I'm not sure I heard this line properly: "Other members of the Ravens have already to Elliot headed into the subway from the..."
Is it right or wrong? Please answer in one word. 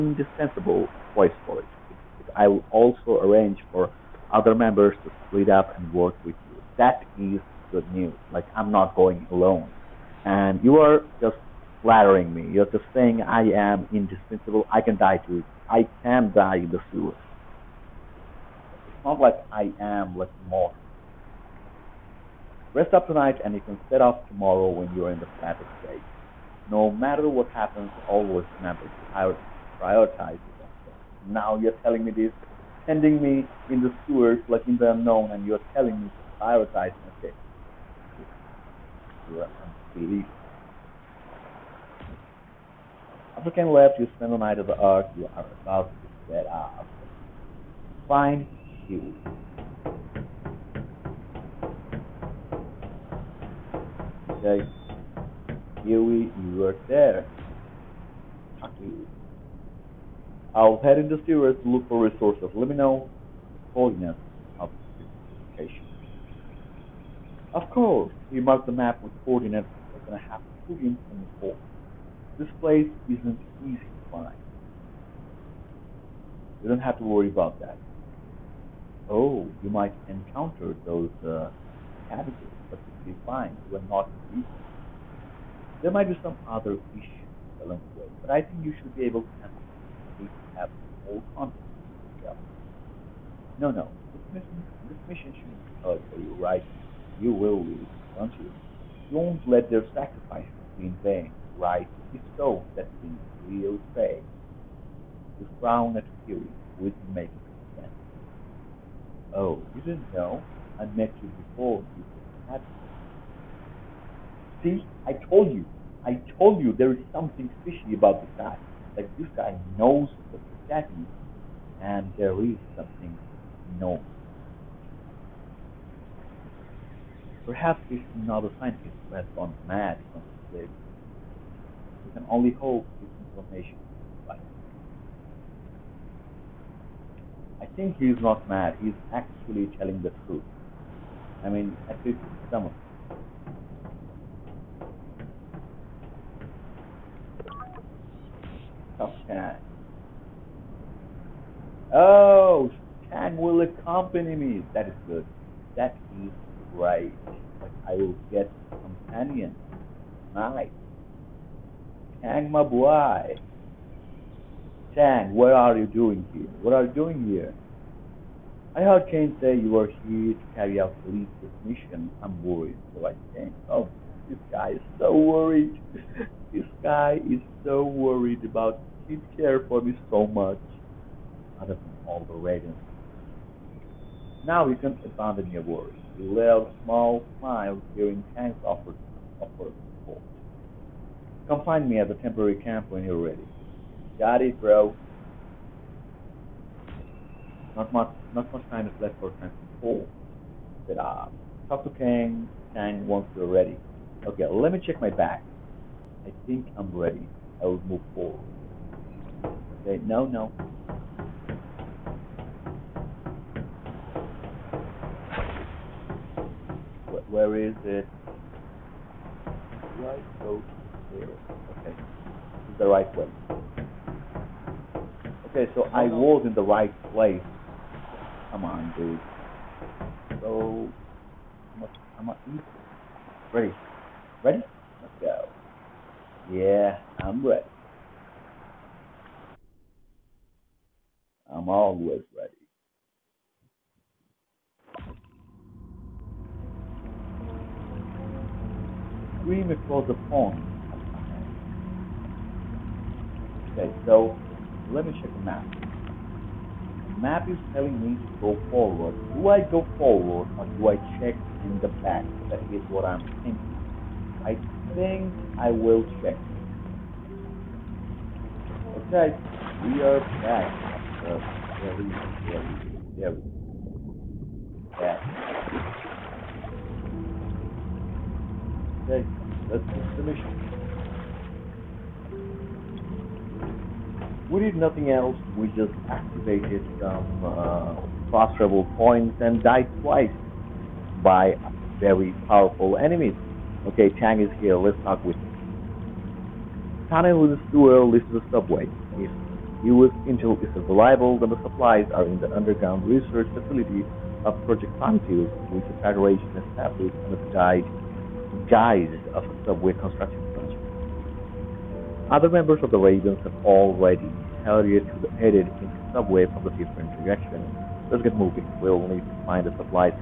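right.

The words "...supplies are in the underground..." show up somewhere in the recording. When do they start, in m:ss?
5:01.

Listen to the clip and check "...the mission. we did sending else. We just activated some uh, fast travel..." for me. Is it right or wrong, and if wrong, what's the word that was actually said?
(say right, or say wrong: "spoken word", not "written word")
wrong: "nothing", not "sending".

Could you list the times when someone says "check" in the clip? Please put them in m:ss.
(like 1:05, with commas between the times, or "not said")
3:24, 4:15, 4:21, 4:26.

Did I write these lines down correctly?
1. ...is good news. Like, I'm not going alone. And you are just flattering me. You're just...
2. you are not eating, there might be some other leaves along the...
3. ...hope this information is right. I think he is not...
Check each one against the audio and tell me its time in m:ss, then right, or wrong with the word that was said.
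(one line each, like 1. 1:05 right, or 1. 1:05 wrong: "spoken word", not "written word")
1. 0:07 right
2. 1:23 wrong: "issues", not "leaves"
3. 2:12 right.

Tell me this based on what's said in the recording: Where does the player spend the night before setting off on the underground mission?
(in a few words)
The Ark.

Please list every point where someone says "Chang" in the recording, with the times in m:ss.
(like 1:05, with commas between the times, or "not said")
2:33, 2:42, 4:54.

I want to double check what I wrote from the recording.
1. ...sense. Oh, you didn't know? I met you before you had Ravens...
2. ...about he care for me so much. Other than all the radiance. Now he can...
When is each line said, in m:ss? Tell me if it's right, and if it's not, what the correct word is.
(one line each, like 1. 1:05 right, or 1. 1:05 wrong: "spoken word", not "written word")
1. 1:47 wrong: "See", not "Ravens"
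2. 2:58 right.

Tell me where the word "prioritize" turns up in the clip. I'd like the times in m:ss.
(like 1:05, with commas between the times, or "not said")
0:29, 0:36.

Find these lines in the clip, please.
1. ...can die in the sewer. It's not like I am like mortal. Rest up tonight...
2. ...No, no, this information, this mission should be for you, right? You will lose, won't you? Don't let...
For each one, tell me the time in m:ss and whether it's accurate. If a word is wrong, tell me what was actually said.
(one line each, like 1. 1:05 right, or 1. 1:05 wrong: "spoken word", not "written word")
1. 0:16 right
2. 1:33 wrong: "mission", not "information".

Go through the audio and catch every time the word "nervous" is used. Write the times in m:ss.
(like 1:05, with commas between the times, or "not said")
not said.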